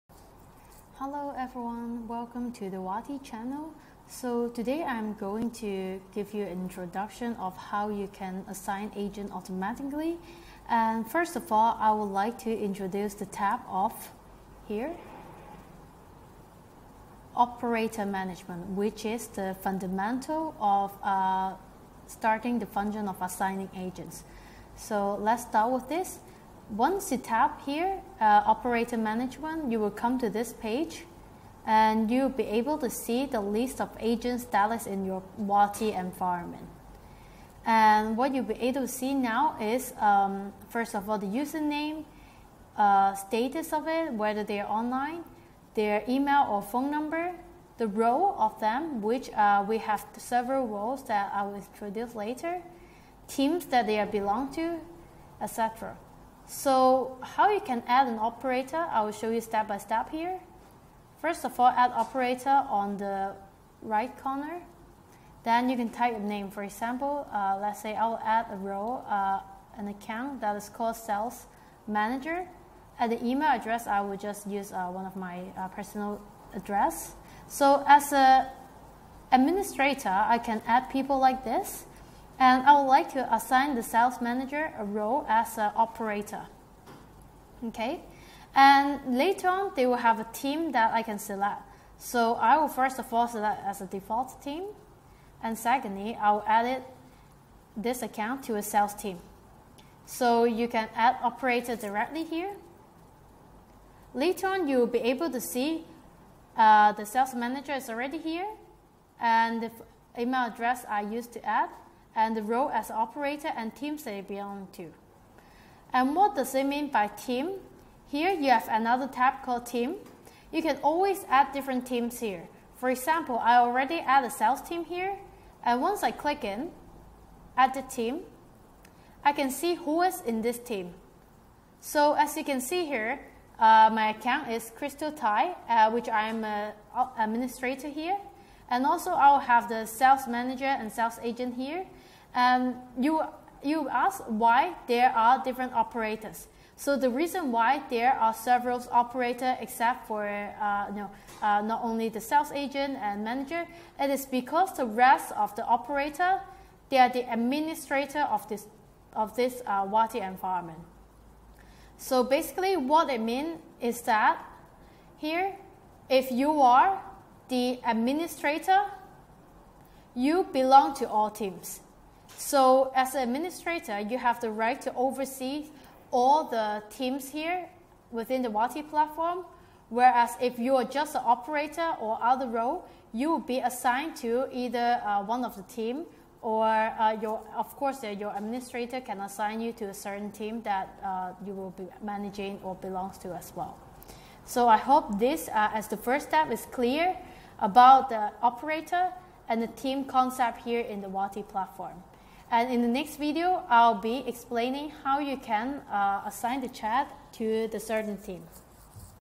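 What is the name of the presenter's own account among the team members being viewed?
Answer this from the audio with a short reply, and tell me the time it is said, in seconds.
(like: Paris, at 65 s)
Crystal Thai, at 134 s.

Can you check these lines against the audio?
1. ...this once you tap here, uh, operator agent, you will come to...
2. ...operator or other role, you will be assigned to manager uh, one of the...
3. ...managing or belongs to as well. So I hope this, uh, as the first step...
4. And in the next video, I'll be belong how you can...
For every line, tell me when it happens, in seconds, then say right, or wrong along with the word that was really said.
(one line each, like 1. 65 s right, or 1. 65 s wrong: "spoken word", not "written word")
1. 25 s wrong: "management", not "agent"
2. 181 s wrong: "either", not "manager"
3. 192 s right
4. 202 s wrong: "explaining", not "belong".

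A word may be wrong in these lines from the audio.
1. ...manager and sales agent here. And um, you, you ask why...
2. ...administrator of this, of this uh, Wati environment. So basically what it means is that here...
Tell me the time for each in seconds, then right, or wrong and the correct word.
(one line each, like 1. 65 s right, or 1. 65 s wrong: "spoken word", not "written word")
1. 140 s right
2. 157 s right.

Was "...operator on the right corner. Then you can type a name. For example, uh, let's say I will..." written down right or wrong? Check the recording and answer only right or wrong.
right.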